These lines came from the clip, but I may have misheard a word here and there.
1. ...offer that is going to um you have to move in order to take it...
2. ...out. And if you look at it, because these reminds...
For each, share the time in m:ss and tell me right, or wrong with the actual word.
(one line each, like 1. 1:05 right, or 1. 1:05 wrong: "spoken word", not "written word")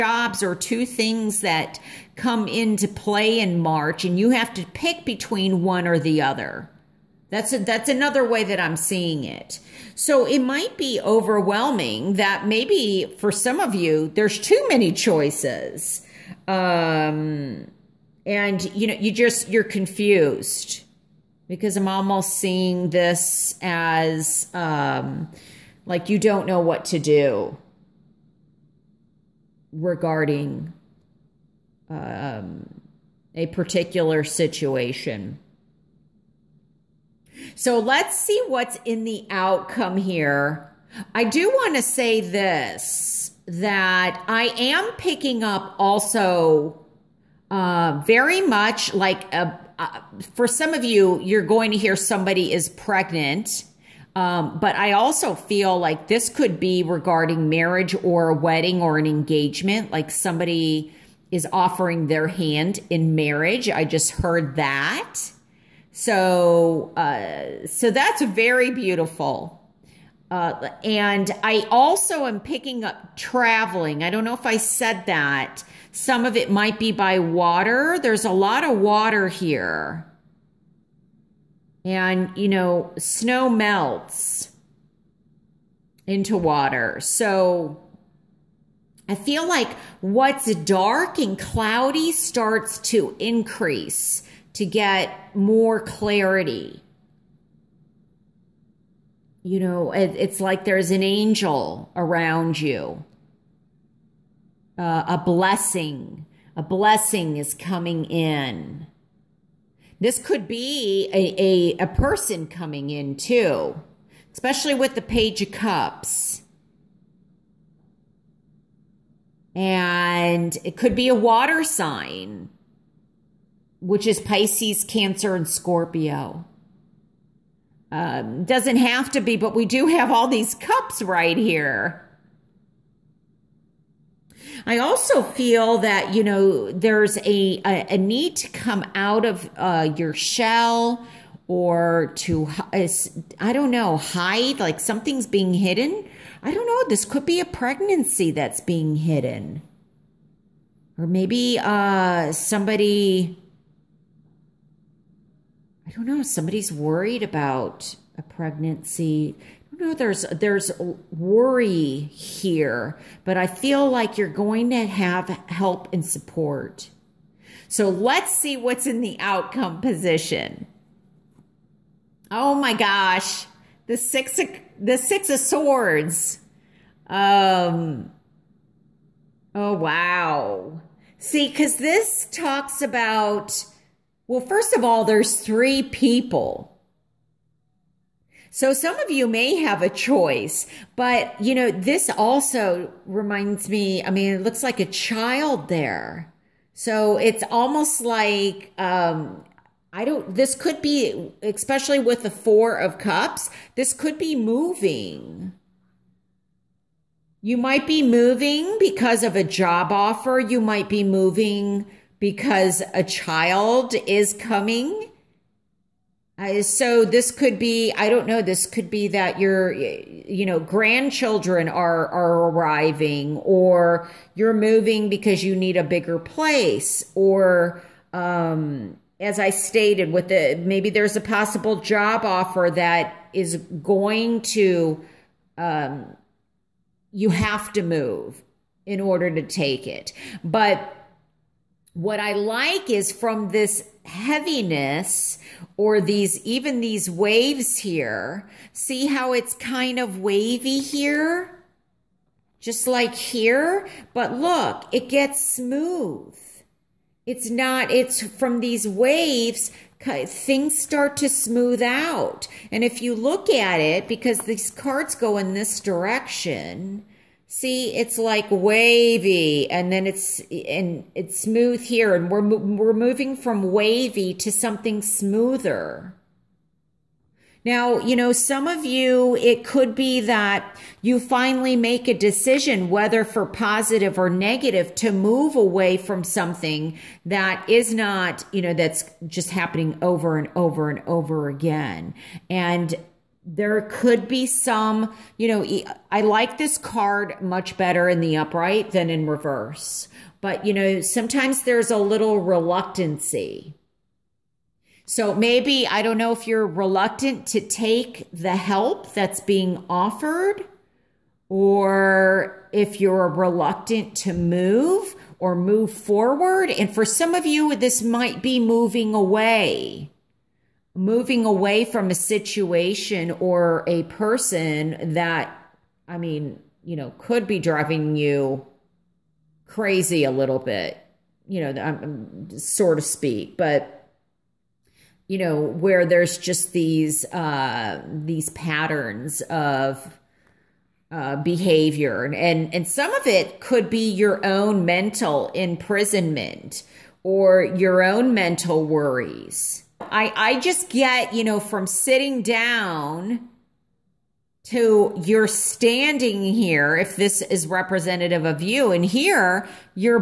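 1. 3:52 right
2. 4:21 wrong: "cards", not "reminds".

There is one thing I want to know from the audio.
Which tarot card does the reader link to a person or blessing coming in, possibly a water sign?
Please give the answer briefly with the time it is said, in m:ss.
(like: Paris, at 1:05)
Page of Cups, at 1:55.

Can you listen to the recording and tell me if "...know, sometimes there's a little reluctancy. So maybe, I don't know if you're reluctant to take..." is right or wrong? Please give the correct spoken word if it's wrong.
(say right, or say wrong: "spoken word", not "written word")
right.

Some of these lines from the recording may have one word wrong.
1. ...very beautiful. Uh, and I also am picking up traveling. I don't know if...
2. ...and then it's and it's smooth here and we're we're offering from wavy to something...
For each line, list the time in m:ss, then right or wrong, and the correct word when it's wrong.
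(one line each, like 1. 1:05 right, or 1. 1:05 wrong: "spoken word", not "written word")
1. 1:08 right
2. 4:29 wrong: "moving", not "offering".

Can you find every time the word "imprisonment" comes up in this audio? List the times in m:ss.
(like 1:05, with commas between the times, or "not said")
5:45.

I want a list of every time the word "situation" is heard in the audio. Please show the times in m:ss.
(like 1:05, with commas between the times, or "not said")
0:34, 5:22.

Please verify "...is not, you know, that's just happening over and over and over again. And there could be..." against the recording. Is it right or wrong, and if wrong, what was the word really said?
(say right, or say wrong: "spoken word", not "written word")
right.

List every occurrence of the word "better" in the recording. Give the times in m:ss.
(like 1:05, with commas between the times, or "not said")
4:57.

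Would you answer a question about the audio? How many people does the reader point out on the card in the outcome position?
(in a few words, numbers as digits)
3.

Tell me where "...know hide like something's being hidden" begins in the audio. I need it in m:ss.
2:23.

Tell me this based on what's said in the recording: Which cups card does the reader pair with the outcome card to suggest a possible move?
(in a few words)
Four of Cups.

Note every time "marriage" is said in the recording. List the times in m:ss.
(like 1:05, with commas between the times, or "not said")
0:57, 1:03.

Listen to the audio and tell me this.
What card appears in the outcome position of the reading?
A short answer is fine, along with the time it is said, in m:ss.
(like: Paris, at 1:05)
Six of Swords, at 2:54.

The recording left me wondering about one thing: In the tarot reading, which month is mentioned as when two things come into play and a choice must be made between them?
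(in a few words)
March.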